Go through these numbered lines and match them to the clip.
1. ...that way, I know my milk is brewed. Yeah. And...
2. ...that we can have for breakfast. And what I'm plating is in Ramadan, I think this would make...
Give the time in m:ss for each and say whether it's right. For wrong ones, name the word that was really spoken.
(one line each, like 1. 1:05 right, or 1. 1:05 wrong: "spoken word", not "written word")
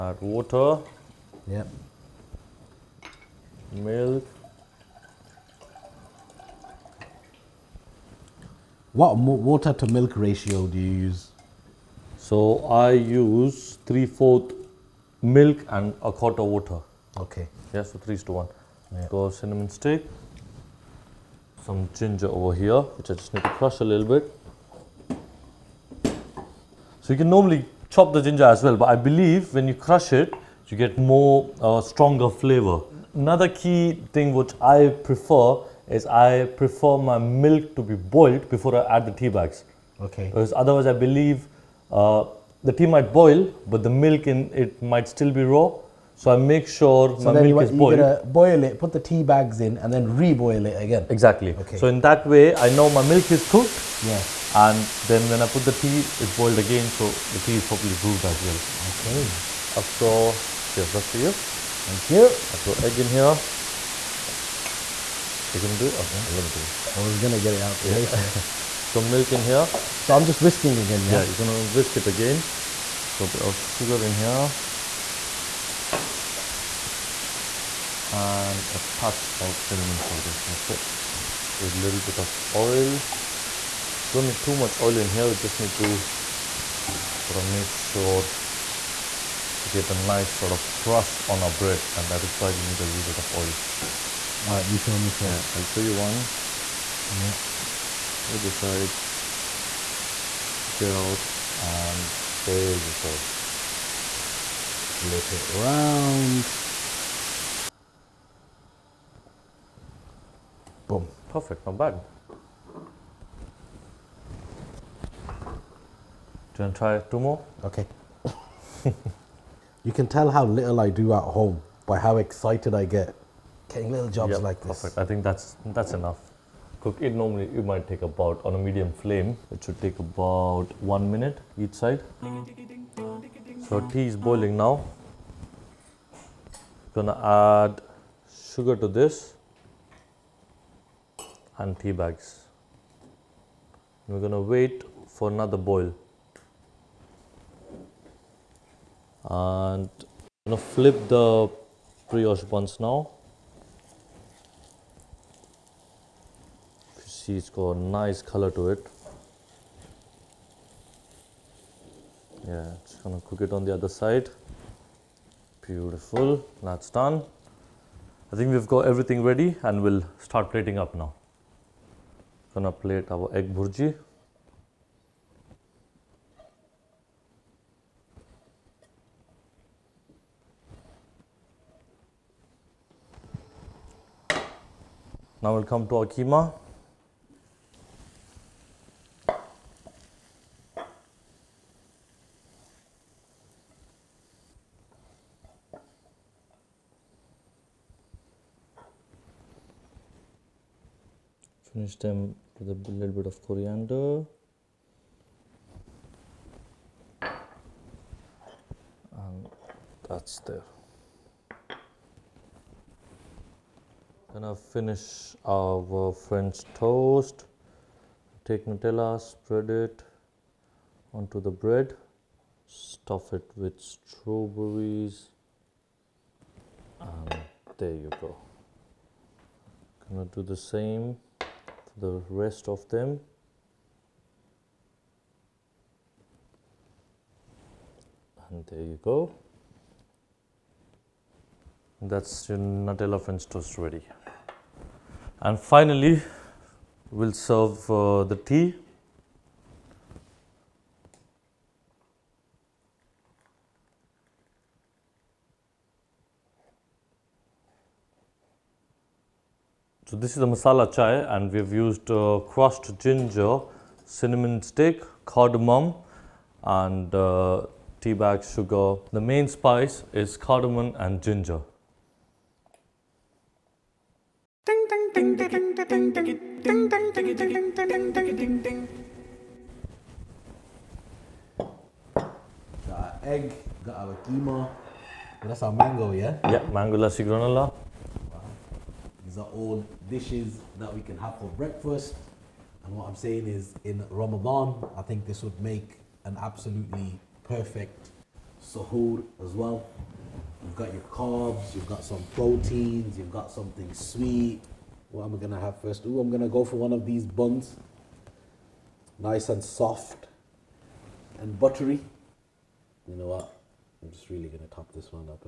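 1. 0:51 wrong: "cooked", not "brewed"
2. 4:50 wrong: "saying", not "plating".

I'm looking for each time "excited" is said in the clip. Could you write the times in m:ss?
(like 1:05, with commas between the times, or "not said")
2:02.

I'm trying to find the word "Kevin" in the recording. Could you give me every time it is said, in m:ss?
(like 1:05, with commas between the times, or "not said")
not said.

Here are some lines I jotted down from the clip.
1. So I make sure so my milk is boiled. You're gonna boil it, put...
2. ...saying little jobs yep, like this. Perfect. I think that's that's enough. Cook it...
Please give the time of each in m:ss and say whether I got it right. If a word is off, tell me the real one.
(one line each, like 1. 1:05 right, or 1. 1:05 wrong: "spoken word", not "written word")
1. 0:46 right
2. 2:03 wrong: "getting", not "saying".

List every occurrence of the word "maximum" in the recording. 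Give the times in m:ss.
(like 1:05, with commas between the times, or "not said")
not said.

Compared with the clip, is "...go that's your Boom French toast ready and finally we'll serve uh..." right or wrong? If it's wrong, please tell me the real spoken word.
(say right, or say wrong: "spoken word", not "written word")
wrong: "Nutella", not "Boom".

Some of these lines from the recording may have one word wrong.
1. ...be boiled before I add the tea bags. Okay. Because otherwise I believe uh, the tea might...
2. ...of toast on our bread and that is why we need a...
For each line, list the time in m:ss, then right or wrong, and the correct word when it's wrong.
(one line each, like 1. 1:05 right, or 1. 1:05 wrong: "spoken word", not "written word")
1. 0:37 right
2. 1:30 wrong: "crust", not "toast".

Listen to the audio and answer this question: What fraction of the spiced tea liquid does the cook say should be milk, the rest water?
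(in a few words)
3/4.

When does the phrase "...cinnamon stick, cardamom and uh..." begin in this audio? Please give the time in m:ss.
4:24.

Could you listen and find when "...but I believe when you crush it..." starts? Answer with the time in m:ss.
0:28.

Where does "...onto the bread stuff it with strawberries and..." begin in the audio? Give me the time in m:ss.
3:41.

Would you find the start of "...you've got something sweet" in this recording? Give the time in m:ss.
5:03.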